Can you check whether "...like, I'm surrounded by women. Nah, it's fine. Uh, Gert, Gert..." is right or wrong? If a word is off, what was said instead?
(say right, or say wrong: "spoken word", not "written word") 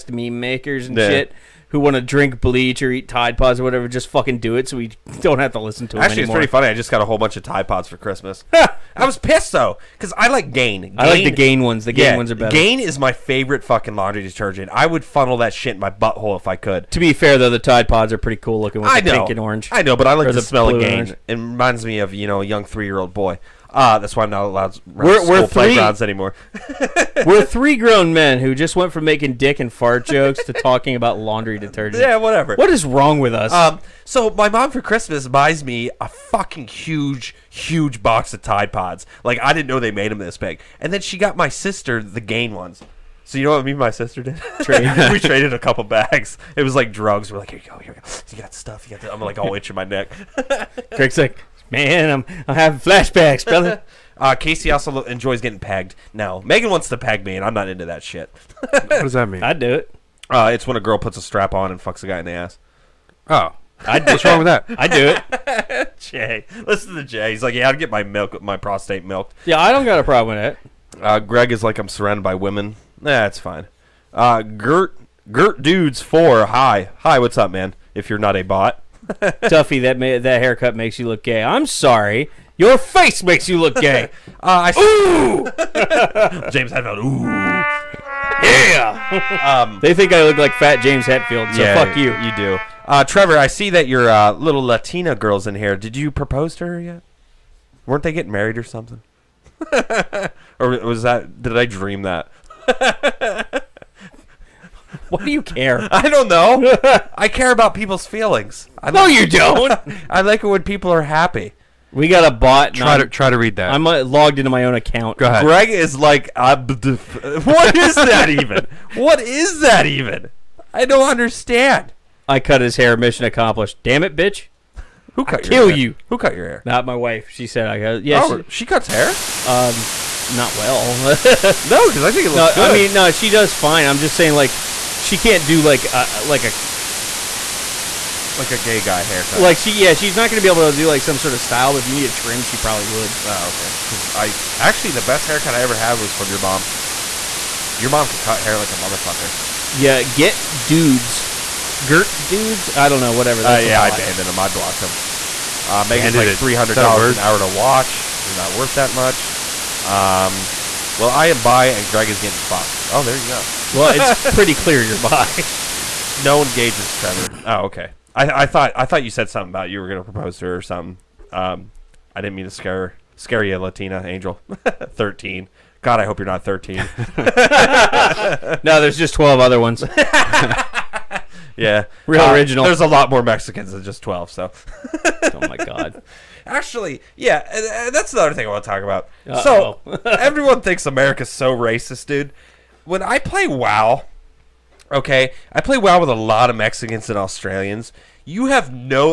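right.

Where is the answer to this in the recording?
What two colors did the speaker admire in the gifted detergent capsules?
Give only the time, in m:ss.
0:19.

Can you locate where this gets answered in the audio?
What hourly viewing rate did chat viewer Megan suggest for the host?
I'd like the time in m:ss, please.
2:36.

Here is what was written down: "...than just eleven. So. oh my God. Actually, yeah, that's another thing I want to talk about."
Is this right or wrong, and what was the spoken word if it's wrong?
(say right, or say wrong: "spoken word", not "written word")
wrong: "twelve", not "eleven".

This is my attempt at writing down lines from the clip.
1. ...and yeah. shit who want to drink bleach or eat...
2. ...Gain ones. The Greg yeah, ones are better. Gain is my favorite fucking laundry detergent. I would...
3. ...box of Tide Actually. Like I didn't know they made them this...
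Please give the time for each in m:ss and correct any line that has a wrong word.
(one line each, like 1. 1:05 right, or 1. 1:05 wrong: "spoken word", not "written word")
1. 0:00 right
2. 0:11 wrong: "Gain", not "Greg"
3. 0:38 wrong: "Pods", not "Actually".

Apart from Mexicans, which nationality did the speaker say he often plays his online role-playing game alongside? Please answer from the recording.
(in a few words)
Australians.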